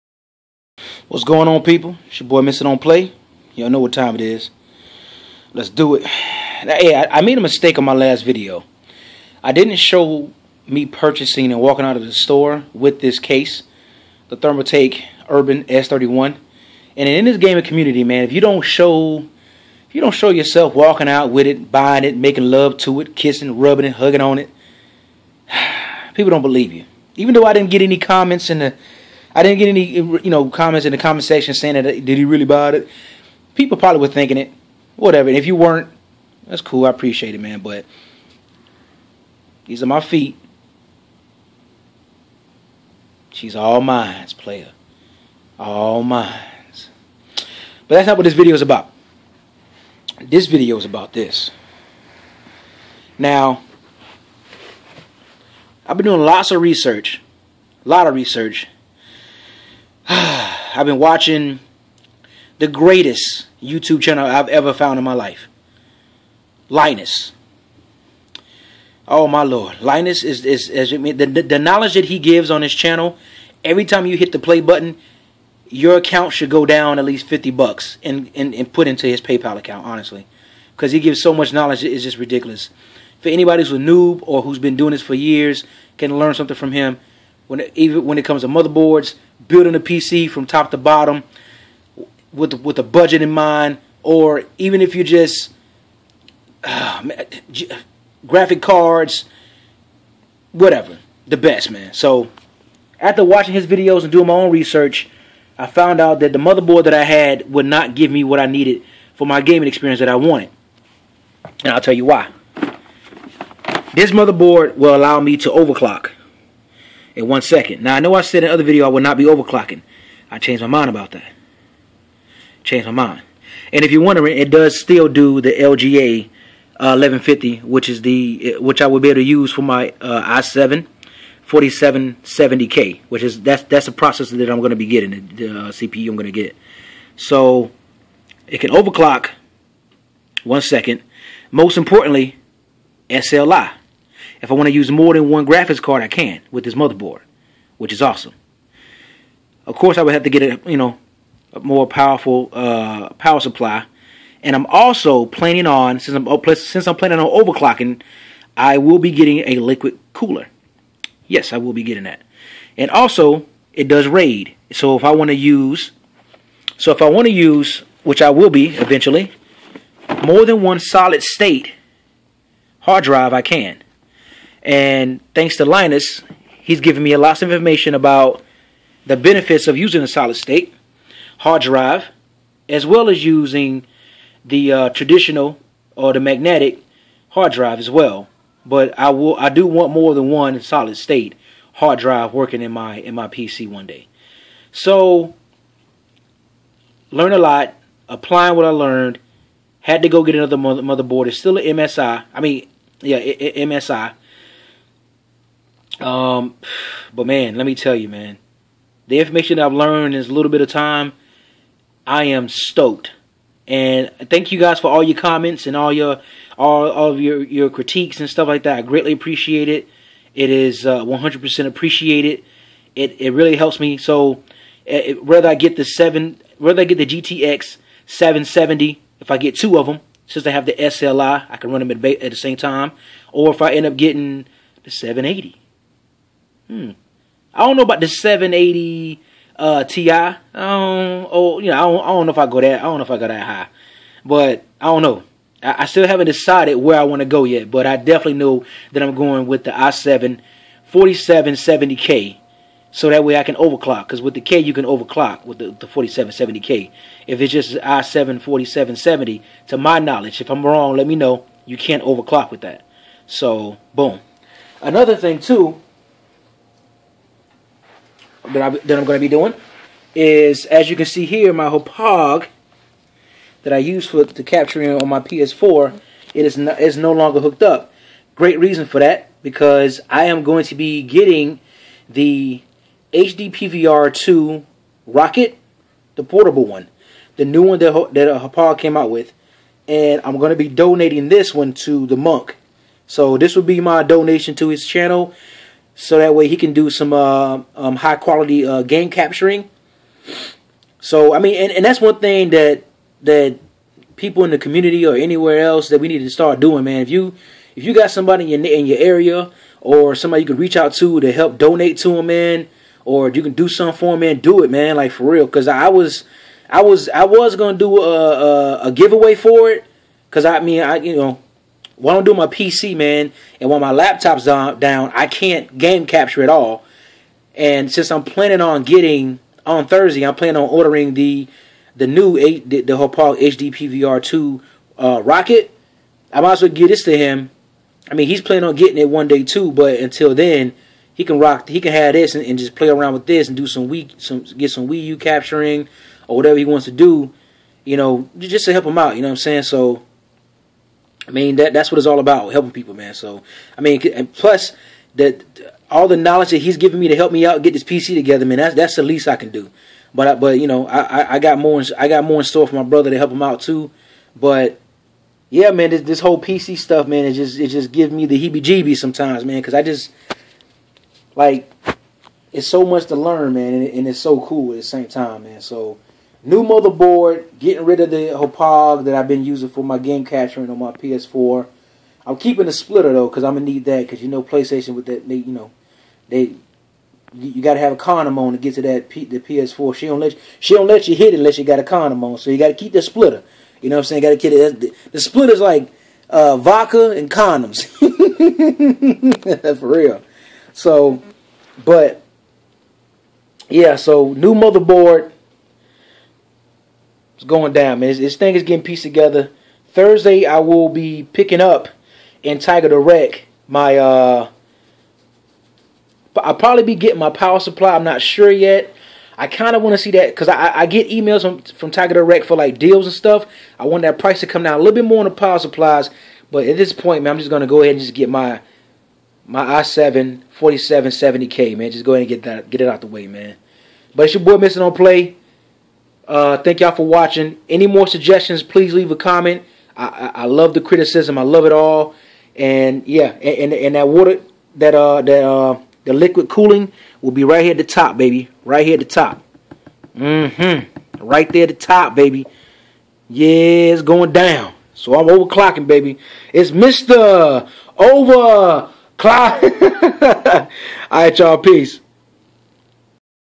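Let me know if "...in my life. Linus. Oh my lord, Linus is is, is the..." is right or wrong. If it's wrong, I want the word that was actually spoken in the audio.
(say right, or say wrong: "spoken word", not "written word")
right.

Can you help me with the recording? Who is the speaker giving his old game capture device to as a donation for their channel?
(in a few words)
the Monk.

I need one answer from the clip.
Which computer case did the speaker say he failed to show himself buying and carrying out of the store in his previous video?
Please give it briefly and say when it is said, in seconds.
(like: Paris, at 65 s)
Thermaltake Urban S31, at 14 s.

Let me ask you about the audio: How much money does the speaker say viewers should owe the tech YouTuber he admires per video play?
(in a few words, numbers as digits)
50 bucks.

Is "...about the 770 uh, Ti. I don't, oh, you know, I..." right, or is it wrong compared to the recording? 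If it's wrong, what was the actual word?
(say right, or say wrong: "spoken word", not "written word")
wrong: "780", not "770".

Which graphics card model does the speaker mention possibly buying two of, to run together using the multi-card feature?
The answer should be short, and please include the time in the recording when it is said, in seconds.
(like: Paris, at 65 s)
GTX 770, at 227 s.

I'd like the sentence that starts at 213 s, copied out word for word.
And thank you guys for all your comments and all your all, all of your your critiques and stuff like that.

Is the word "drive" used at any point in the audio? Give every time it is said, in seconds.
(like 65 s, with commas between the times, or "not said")
173 s, 181 s, 187 s, 191 s.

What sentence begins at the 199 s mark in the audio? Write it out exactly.
Had to go get another motherboard.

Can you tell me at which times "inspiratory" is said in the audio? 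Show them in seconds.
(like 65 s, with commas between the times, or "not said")
not said.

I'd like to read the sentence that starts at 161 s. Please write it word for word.
Yes, I will be getting that, and also it does RAID.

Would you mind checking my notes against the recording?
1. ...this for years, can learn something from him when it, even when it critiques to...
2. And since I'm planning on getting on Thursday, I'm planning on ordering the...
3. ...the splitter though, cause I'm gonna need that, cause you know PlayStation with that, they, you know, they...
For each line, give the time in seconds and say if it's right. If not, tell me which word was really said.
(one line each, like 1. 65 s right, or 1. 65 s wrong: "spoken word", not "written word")
1. 84 s wrong: "comes", not "critiques"
2. 327 s right
3. 382 s right.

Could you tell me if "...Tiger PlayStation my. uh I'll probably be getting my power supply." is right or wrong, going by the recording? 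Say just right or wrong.
wrong.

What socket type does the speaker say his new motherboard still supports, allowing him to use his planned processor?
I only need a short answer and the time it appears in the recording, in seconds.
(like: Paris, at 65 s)
LGA 1150, at 125 s.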